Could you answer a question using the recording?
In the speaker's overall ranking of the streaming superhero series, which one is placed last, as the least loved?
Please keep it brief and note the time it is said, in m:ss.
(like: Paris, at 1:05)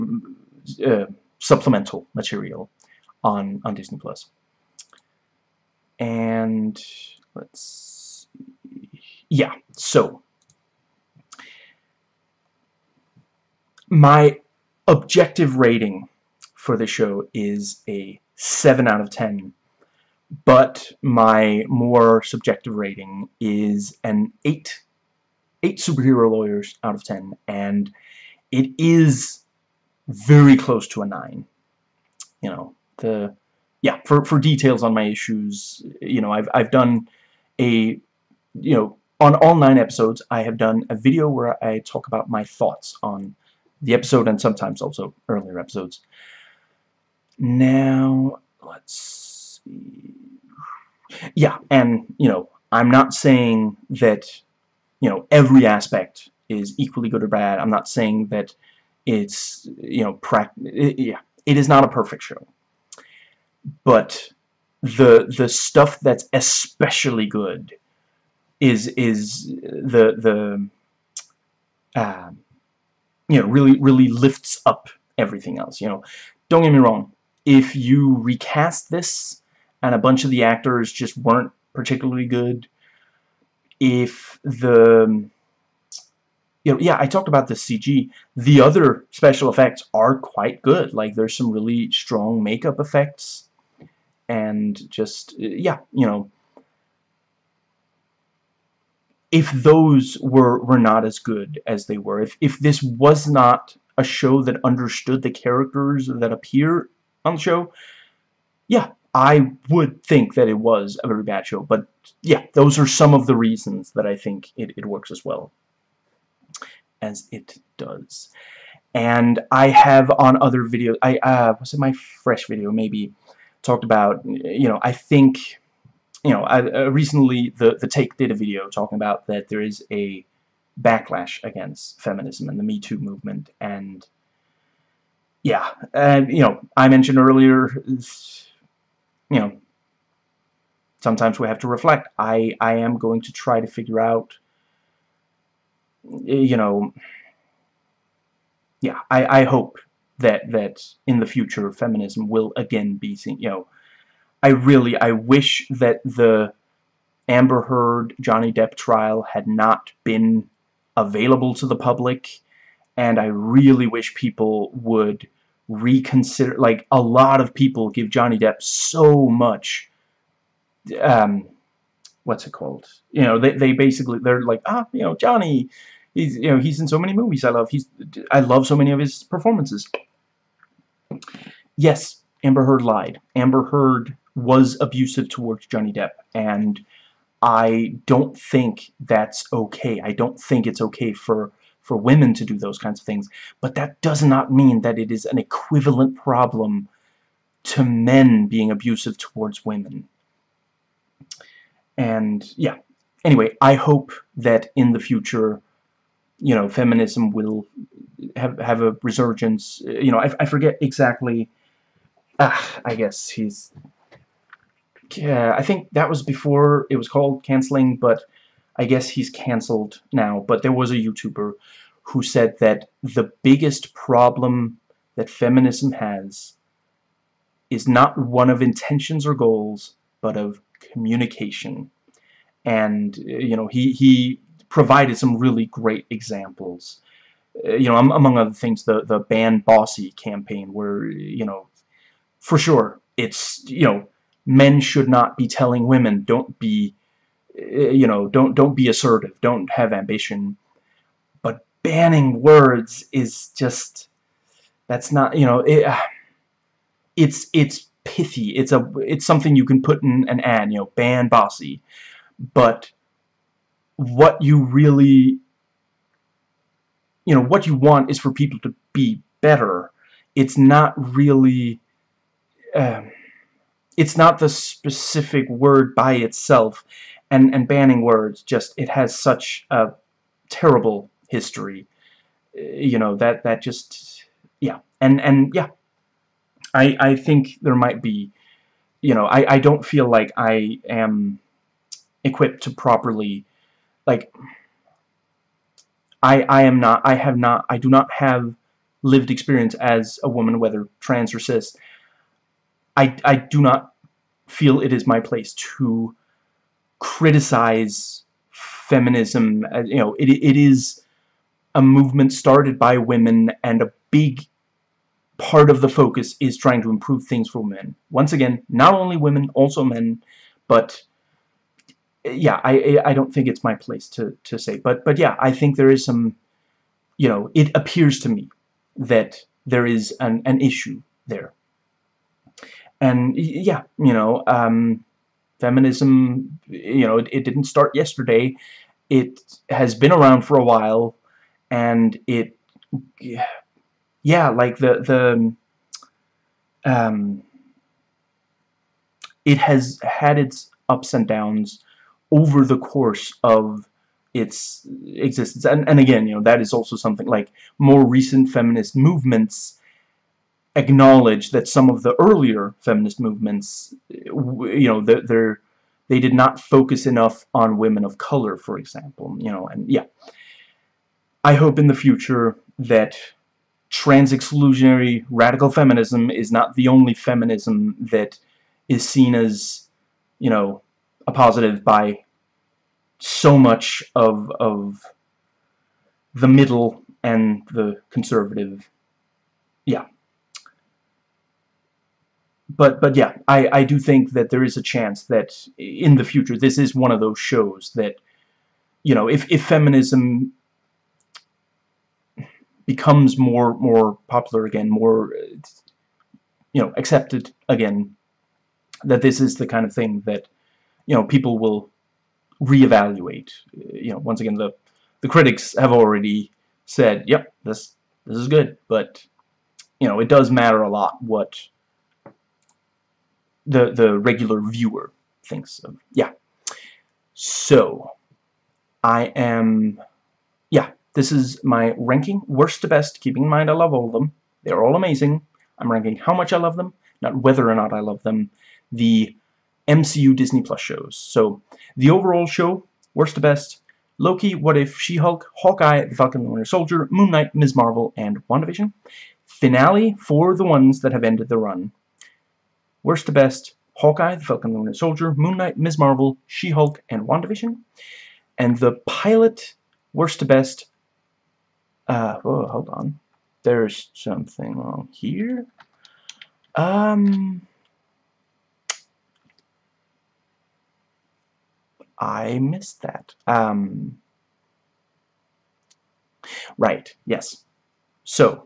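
Loki, at 7:24.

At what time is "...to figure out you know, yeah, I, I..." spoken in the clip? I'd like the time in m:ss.
2:23.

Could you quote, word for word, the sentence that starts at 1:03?
But the the stuff that's especially good is is the the uh, you know really really lifts up everything else.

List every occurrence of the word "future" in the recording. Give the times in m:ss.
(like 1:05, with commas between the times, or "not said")
2:31, 3:24, 6:11, 6:36.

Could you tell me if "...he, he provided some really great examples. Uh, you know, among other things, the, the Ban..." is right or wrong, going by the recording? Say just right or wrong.
right.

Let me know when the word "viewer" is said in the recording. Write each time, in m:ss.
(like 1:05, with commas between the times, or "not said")
7:04.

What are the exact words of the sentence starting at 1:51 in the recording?
But, yeah, those are some of the reasons that I think it, it works as well as it does.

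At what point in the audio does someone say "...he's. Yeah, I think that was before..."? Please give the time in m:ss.
3:33.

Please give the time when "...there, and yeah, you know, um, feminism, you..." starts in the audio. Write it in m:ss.
5:31.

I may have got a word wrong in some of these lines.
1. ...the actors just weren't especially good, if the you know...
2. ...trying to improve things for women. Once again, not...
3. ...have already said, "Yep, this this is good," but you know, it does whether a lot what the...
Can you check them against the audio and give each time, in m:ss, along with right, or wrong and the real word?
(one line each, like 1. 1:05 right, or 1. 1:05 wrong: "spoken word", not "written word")
1. 1:20 wrong: "particularly", not "especially"
2. 5:16 right
3. 6:55 wrong: "matter", not "whether".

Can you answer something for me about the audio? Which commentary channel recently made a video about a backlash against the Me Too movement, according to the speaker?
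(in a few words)
The Take.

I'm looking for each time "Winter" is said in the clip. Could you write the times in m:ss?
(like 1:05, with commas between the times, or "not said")
7:26, 7:34.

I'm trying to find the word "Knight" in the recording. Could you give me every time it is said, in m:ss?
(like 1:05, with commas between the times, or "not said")
7:27, 7:35.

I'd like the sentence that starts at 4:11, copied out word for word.
But banning words is just, that's not, you know, it, uh, it's, it's pithy.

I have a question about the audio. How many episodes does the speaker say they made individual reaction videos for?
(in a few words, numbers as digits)
9.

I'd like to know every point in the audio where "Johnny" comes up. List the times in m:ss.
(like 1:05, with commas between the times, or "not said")
2:38, 2:48, 2:55, 3:05.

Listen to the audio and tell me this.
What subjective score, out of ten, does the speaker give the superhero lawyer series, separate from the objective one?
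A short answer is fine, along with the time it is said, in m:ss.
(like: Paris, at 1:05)
8, at 0:24.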